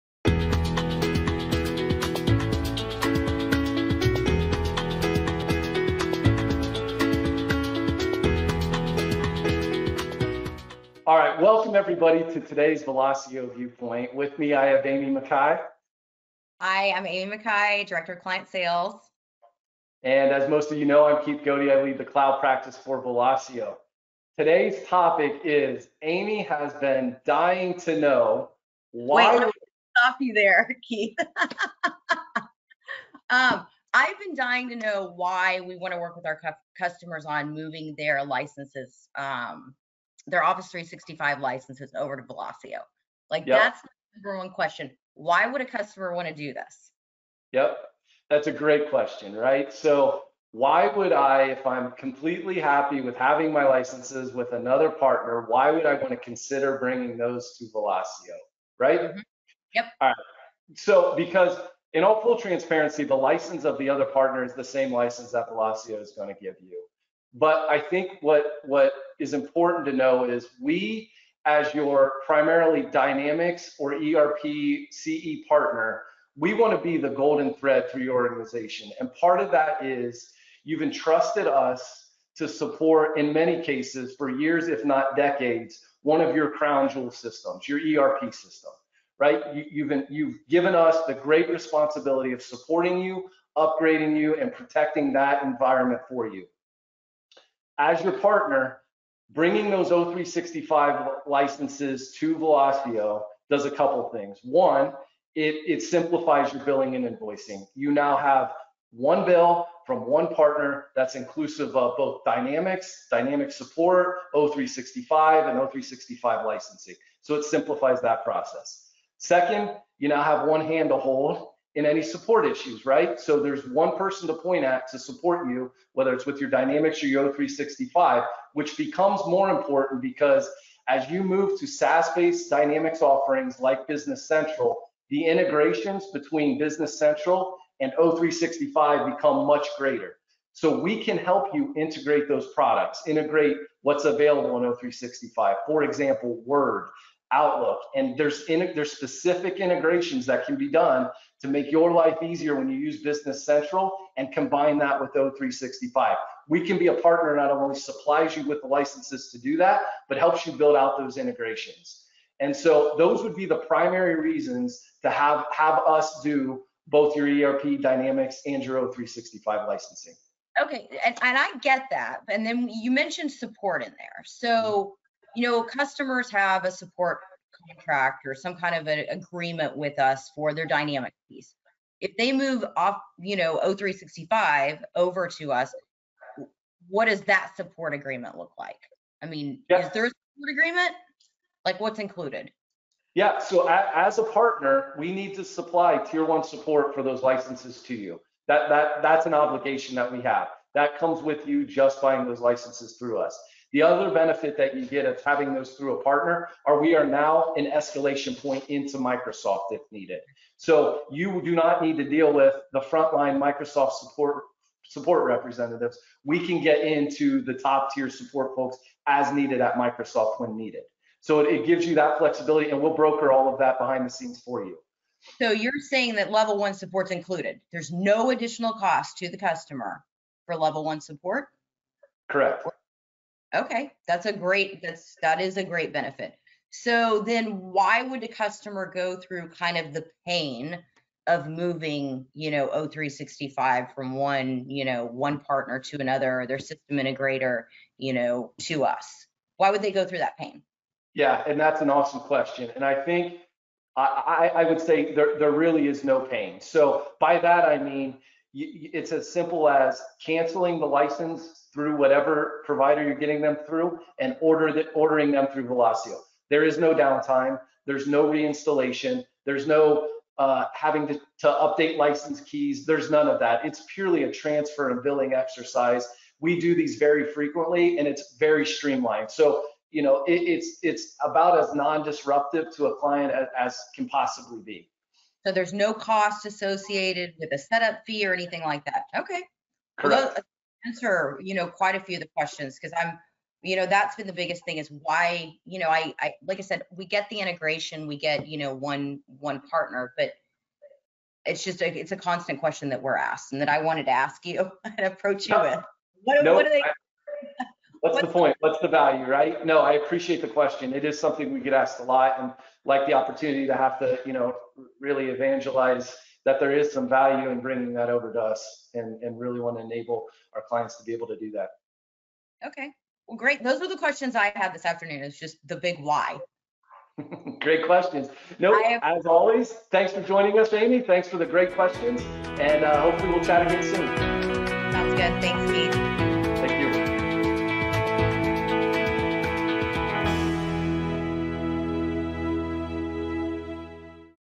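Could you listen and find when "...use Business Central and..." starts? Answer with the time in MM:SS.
02:32.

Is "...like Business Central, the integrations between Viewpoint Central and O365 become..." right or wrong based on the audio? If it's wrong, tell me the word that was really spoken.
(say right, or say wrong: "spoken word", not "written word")
wrong: "Business", not "Viewpoint".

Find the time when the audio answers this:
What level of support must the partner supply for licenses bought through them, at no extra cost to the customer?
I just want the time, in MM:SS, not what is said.
03:15.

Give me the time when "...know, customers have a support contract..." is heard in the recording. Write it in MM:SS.
02:55.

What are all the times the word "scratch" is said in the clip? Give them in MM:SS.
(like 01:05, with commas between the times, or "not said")
not said.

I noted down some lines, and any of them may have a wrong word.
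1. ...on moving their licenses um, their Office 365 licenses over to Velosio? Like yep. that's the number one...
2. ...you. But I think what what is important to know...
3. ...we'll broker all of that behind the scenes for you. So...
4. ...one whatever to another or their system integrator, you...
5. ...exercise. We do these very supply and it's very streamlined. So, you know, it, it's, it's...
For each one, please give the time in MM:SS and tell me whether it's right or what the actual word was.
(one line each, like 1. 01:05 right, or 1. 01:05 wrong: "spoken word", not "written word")
1. 00:37 right
2. 01:06 right
3. 03:42 right
4. 04:05 wrong: "partner", not "whatever"
5. 04:35 wrong: "frequently", not "supply".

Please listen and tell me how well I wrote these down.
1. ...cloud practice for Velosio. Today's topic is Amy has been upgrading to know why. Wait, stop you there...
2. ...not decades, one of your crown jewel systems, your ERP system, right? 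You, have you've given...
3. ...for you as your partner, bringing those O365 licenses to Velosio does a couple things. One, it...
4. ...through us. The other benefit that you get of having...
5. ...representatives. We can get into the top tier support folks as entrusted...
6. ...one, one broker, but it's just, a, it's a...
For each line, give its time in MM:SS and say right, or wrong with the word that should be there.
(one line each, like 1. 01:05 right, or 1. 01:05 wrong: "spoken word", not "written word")
1. 00:22 wrong: "dying", not "upgrading"
2. 01:24 right
3. 01:36 right
4. 03:22 right
5. 03:35 wrong: "needed", not "entrusted"
6. 04:58 wrong: "partner", not "broker".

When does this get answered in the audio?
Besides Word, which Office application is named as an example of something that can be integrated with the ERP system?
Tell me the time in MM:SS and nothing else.
02:27.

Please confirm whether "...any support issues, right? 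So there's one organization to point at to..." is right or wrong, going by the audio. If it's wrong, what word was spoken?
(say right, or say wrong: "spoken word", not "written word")
wrong: "person", not "organization".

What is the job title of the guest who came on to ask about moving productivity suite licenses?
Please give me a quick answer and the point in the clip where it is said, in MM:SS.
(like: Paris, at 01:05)
Director of Client Sales, at 00:17.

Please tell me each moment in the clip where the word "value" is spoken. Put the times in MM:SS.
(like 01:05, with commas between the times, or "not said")
05:08, 05:17.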